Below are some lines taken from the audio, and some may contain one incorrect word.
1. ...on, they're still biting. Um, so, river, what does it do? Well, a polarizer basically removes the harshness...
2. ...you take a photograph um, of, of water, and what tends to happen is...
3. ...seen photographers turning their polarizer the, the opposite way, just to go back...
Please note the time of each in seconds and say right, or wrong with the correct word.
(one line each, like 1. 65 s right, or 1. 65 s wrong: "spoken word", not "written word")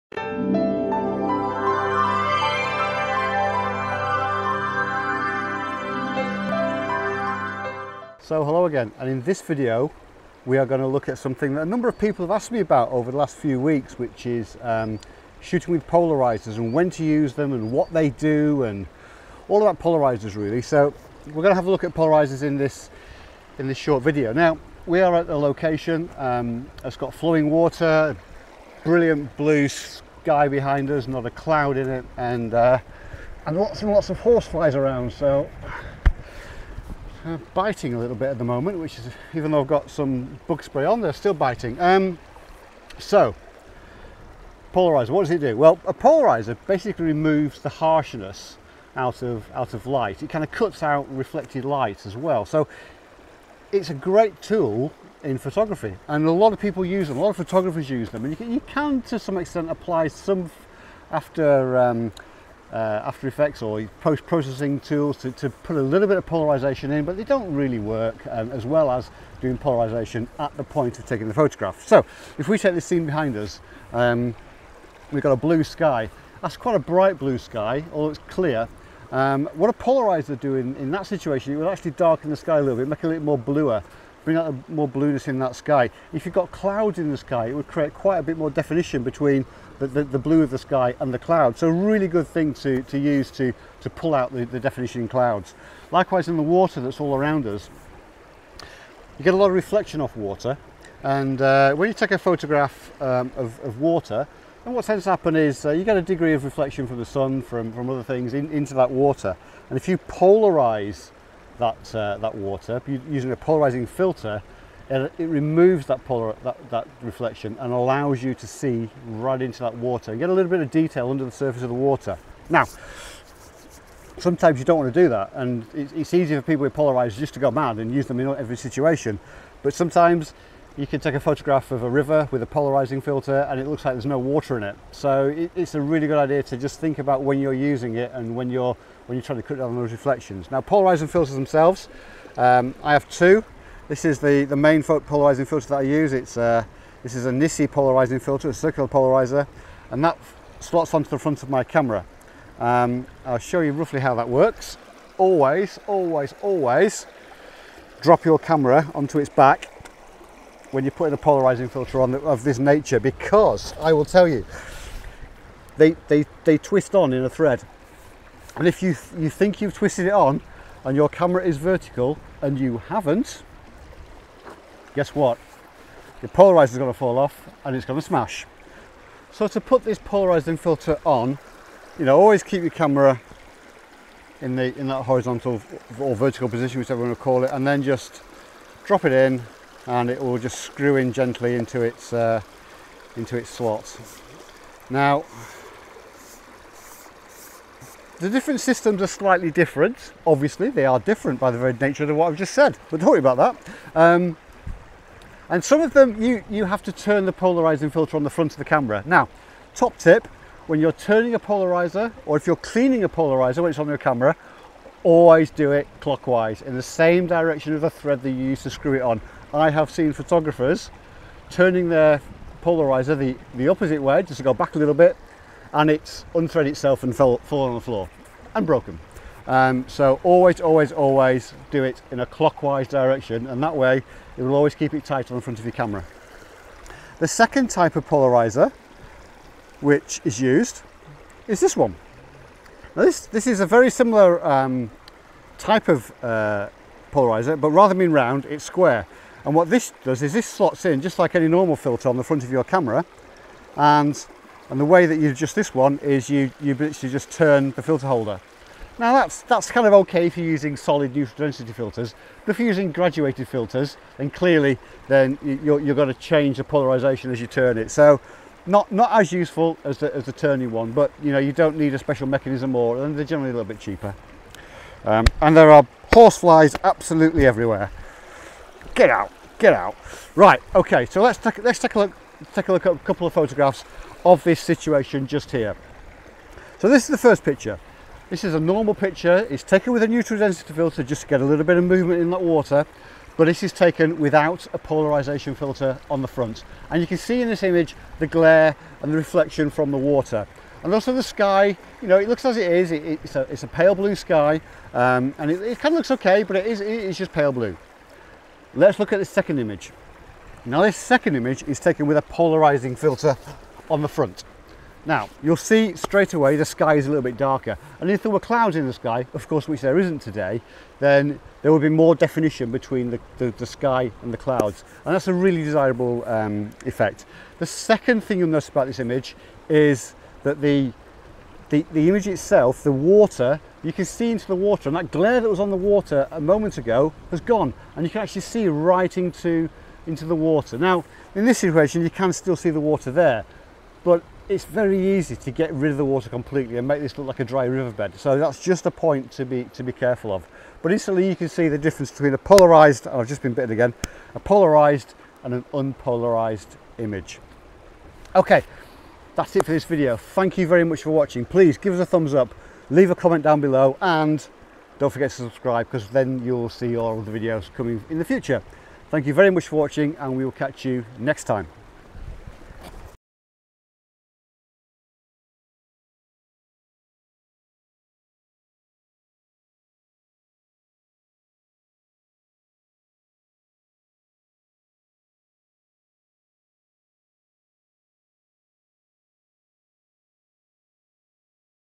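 1. 40 s wrong: "polarizer", not "river"
2. 101 s right
3. 219 s right.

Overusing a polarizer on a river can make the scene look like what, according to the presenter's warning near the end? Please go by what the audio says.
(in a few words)
dry riverbed.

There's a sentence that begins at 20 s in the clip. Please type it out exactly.
So we're going to have a look at polarizers in this in this short video.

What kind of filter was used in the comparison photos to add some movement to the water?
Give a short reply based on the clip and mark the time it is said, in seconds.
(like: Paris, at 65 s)
neutral density filter, at 290 s.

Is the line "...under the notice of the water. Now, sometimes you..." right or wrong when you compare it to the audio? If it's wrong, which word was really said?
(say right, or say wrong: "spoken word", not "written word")
wrong: "surface", not "notice".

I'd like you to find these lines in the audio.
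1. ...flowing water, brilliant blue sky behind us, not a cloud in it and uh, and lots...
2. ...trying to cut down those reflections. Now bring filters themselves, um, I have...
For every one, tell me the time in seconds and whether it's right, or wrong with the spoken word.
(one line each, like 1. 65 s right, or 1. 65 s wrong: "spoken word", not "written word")
1. 27 s right
2. 139 s wrong: "polarizing", not "bring".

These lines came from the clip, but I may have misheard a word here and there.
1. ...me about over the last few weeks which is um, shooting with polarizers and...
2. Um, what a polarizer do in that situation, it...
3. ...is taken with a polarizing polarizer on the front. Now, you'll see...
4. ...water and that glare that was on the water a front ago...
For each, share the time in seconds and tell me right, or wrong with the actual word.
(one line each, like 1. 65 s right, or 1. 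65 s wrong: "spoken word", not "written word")
1. 12 s right
2. 79 s right
3. 311 s wrong: "filter", not "polarizer"
4. 334 s wrong: "moment", not "front".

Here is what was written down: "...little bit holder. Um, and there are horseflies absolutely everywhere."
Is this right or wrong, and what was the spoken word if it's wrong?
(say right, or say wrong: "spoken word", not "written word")
wrong: "cheaper", not "holder".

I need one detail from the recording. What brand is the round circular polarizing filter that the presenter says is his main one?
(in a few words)
Nisi.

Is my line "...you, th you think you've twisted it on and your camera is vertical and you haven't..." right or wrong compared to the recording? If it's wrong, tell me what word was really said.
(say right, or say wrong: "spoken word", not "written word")
right.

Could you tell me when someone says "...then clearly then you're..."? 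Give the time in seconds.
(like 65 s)
264 s.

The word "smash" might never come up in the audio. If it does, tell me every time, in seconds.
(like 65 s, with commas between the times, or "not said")
178 s.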